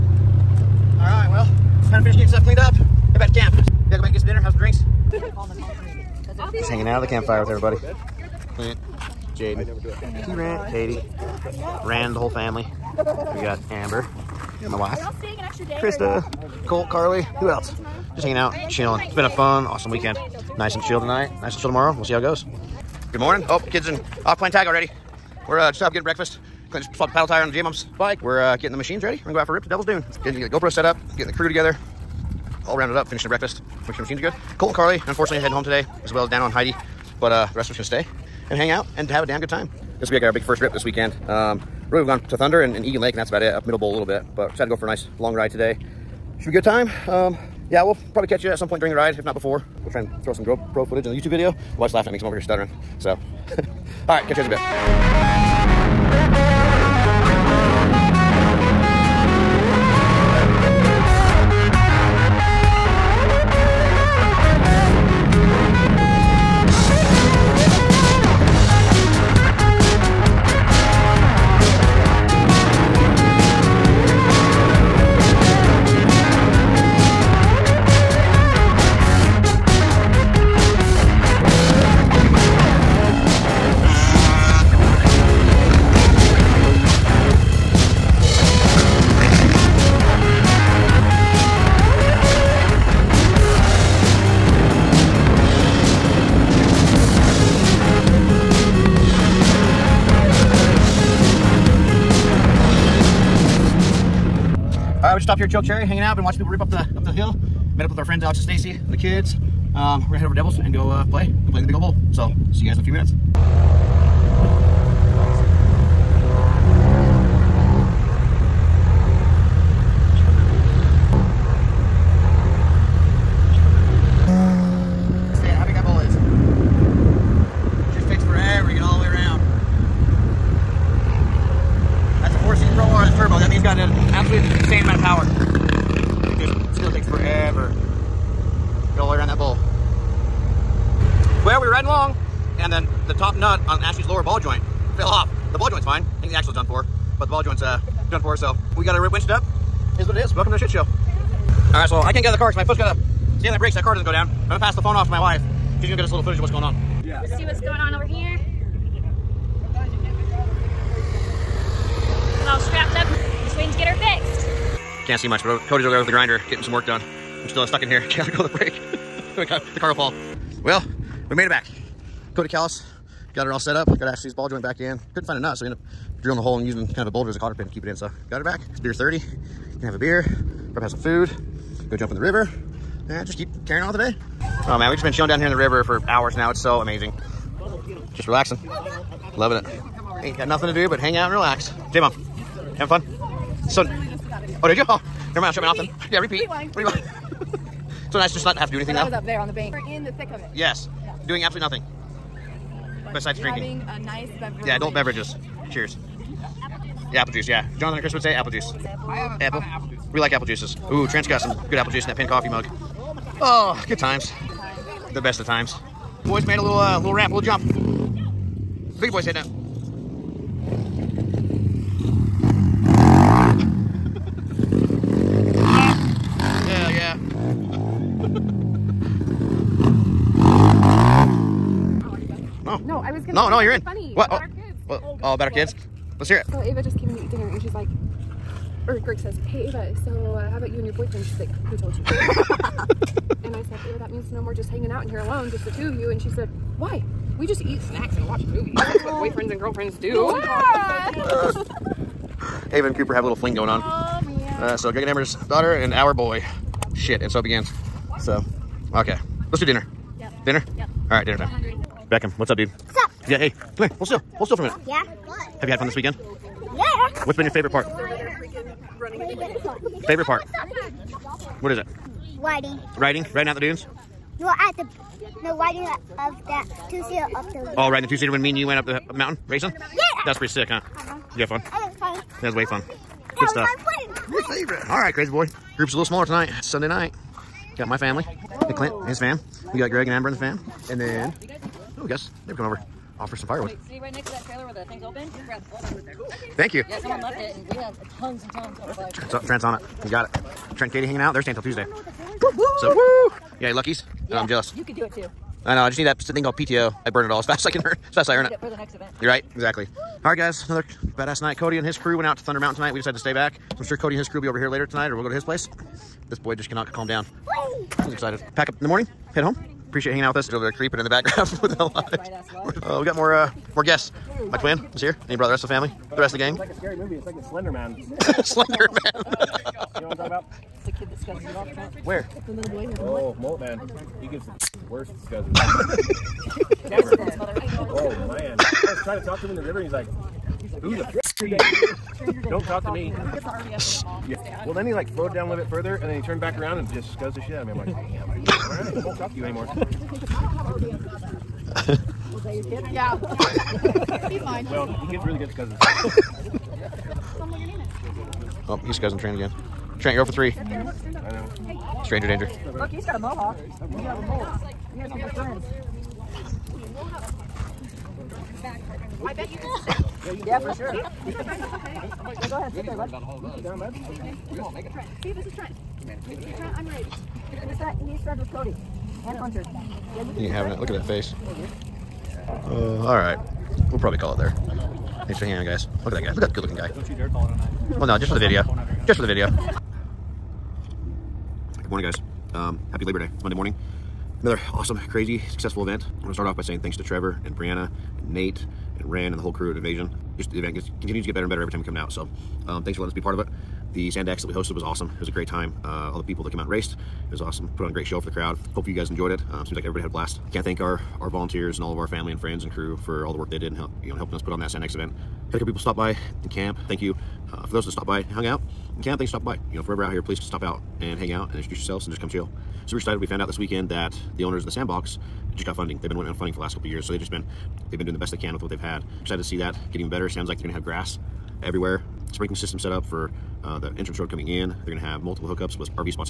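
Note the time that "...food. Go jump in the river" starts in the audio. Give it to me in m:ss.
3:00.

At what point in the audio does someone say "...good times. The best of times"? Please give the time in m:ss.
3:33.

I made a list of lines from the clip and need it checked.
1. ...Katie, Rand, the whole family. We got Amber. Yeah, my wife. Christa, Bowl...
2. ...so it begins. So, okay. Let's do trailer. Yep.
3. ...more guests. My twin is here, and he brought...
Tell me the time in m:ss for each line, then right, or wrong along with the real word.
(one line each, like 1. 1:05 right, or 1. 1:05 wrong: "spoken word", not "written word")
1. 0:10 wrong: "Colt", not "Bowl"
2. 4:17 wrong: "dinner", not "trailer"
3. 5:23 right.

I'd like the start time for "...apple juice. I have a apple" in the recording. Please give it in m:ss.
3:28.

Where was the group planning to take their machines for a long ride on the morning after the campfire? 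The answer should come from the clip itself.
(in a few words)
Devil's Dune.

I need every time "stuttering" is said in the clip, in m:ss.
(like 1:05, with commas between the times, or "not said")
0:52.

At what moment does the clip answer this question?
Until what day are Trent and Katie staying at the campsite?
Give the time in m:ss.
5:01.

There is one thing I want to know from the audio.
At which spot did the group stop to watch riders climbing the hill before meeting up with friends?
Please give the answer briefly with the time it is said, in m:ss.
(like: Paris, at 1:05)
Choke Cherry, at 1:45.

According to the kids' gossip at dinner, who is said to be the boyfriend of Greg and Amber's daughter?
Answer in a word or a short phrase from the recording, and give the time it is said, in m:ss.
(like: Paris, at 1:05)
Cooper, at 4:12.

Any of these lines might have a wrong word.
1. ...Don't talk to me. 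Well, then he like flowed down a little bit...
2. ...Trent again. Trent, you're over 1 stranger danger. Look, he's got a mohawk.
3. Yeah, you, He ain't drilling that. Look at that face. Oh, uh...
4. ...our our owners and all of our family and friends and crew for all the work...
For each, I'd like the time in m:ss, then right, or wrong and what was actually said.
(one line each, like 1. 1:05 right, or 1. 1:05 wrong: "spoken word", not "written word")
1. 5:41 right
2. 5:59 wrong: "3", not "1"
3. 6:20 wrong: "having", not "drilling"
4. 6:50 wrong: "volunteers", not "owners".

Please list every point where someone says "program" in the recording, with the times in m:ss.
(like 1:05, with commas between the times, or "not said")
not said.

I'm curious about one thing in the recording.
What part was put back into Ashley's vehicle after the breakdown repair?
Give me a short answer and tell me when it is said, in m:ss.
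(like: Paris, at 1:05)
ball joint, at 2:54.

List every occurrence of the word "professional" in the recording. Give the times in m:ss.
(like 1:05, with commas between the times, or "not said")
not said.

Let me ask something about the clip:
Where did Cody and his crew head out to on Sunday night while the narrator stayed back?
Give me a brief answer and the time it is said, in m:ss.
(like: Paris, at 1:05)
Thunder Mountain, at 5:12.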